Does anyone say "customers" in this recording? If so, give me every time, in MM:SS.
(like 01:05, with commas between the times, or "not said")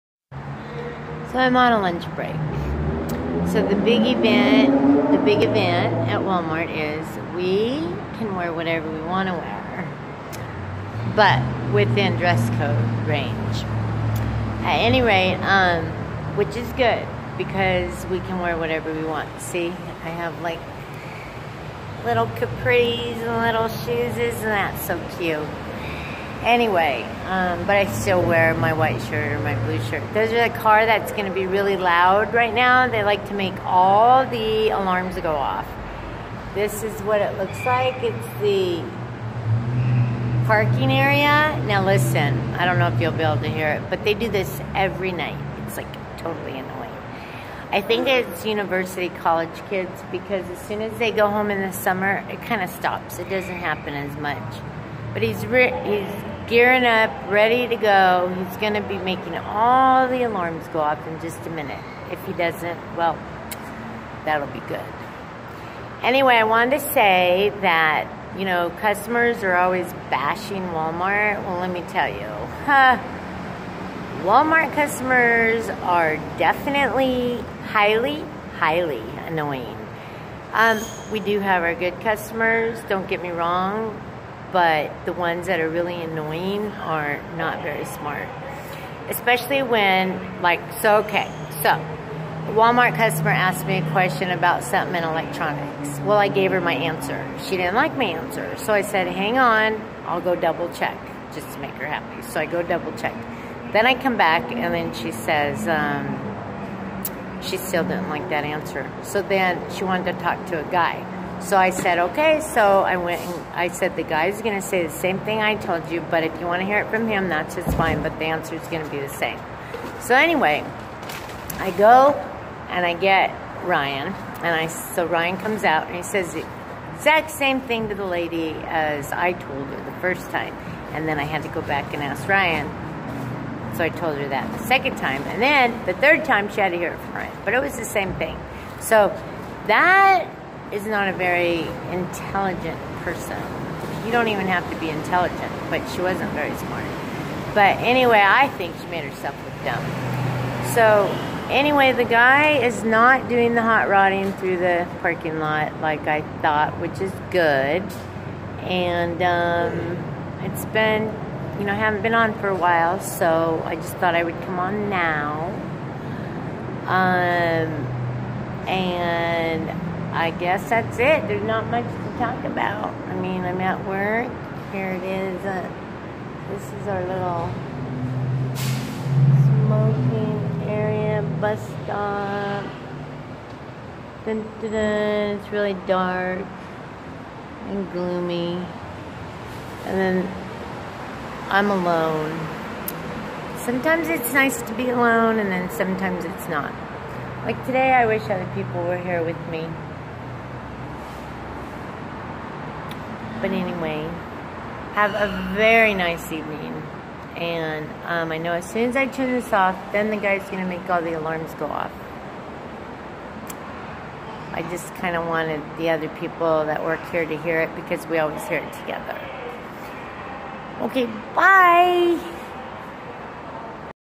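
01:08, 01:14, 01:22, 01:32.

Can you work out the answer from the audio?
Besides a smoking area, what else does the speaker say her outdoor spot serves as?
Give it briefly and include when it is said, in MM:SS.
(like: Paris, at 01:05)
bus stop, at 03:01.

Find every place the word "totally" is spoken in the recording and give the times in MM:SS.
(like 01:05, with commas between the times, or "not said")
00:46.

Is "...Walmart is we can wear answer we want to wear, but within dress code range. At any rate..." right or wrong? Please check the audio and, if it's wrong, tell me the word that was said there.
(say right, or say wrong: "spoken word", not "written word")
wrong: "whatever", not "answer".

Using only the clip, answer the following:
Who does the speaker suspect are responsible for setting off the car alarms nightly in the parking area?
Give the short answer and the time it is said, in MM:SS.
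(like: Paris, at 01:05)
college kids, at 00:49.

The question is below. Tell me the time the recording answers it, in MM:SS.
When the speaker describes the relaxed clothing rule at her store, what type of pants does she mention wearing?
00:22.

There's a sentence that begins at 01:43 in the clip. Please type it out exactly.
Then I come back and then she says, um, she still didn't like that answer.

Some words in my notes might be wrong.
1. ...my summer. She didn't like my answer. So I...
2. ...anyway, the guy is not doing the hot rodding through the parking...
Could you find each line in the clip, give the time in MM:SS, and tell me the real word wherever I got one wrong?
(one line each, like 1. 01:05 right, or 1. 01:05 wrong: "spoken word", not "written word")
1. 01:36 wrong: "answer", not "summer"
2. 02:31 right.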